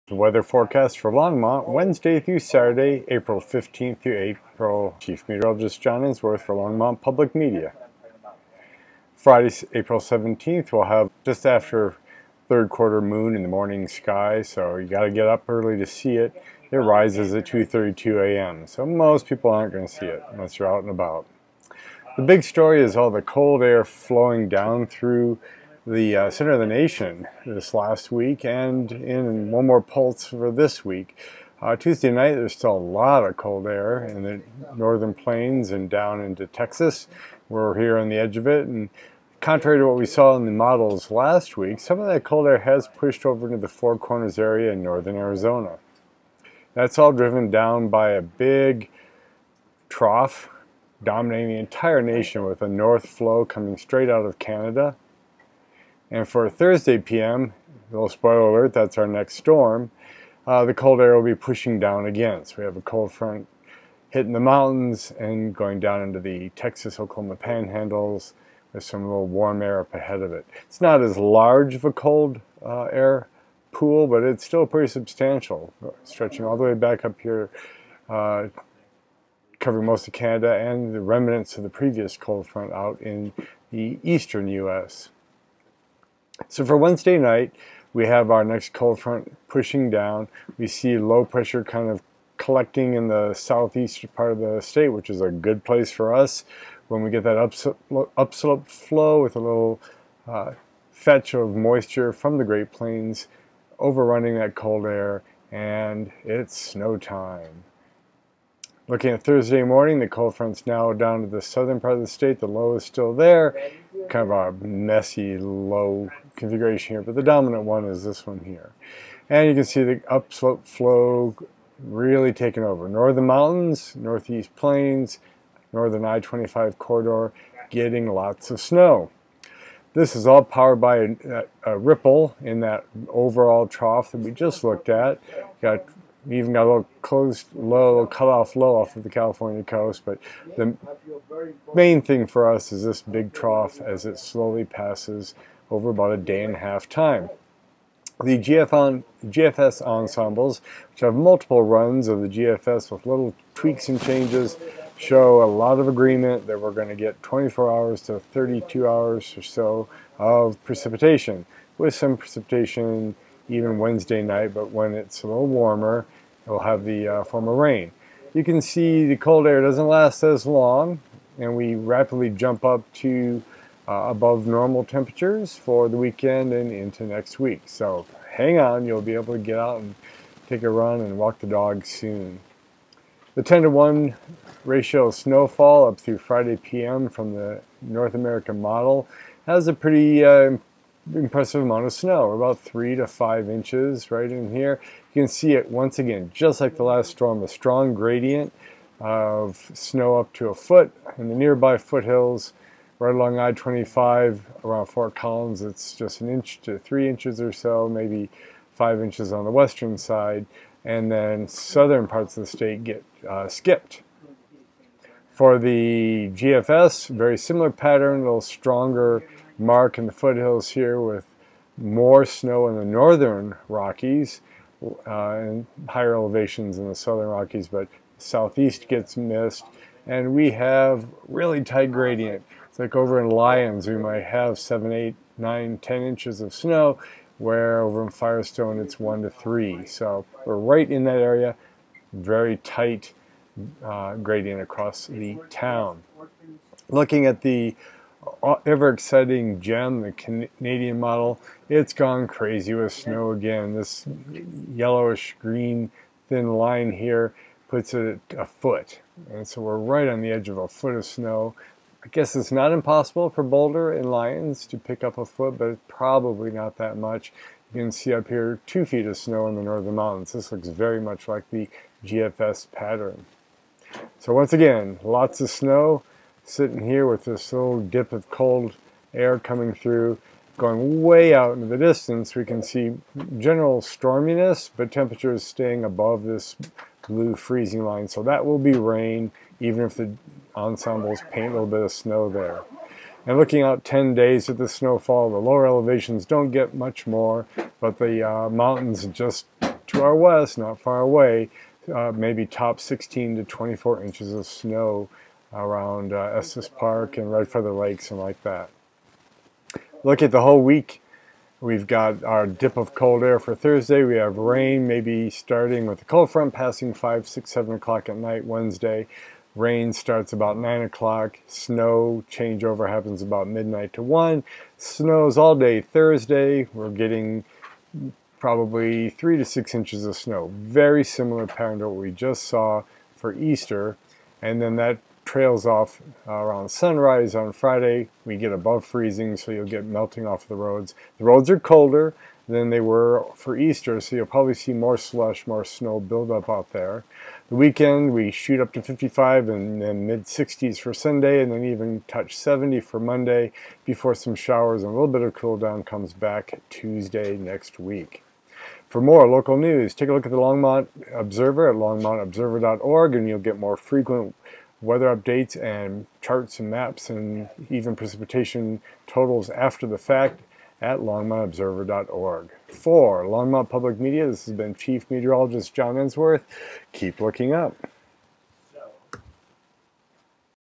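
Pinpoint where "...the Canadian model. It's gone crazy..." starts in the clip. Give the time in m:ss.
4:10.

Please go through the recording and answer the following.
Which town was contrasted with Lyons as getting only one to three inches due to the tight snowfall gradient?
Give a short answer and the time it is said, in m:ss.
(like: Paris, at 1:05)
Firestone, at 3:58.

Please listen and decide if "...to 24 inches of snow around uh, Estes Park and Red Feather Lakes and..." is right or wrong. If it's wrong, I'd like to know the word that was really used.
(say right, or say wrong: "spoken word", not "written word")
right.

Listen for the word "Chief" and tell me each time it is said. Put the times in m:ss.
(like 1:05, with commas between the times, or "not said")
0:04, 6:14.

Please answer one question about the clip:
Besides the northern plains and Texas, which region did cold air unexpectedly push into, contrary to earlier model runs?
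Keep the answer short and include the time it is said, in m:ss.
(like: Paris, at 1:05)
Four Corners, at 0:43.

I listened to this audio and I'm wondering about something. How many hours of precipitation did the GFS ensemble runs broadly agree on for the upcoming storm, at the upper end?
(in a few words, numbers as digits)
32 hours.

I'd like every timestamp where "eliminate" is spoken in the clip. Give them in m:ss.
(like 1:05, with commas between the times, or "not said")
not said.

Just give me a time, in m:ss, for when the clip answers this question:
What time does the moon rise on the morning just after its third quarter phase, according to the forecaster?
0:17.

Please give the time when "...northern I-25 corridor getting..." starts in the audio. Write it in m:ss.
2:05.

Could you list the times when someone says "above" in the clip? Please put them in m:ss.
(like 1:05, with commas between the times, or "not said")
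2:54, 4:45, 5:38.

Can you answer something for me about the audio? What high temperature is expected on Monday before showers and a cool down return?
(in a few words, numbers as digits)
70.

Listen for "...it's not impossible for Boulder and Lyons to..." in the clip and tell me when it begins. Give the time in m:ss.
4:22.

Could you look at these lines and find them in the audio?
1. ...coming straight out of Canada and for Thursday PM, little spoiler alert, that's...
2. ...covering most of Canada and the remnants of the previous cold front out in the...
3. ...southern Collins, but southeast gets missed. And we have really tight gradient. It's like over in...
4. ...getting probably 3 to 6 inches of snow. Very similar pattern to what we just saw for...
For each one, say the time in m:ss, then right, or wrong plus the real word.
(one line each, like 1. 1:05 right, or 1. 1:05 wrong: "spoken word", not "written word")
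1. 0:53 right
2. 1:19 right
3. 3:46 wrong: "Rockies", not "Collins"
4. 5:26 right.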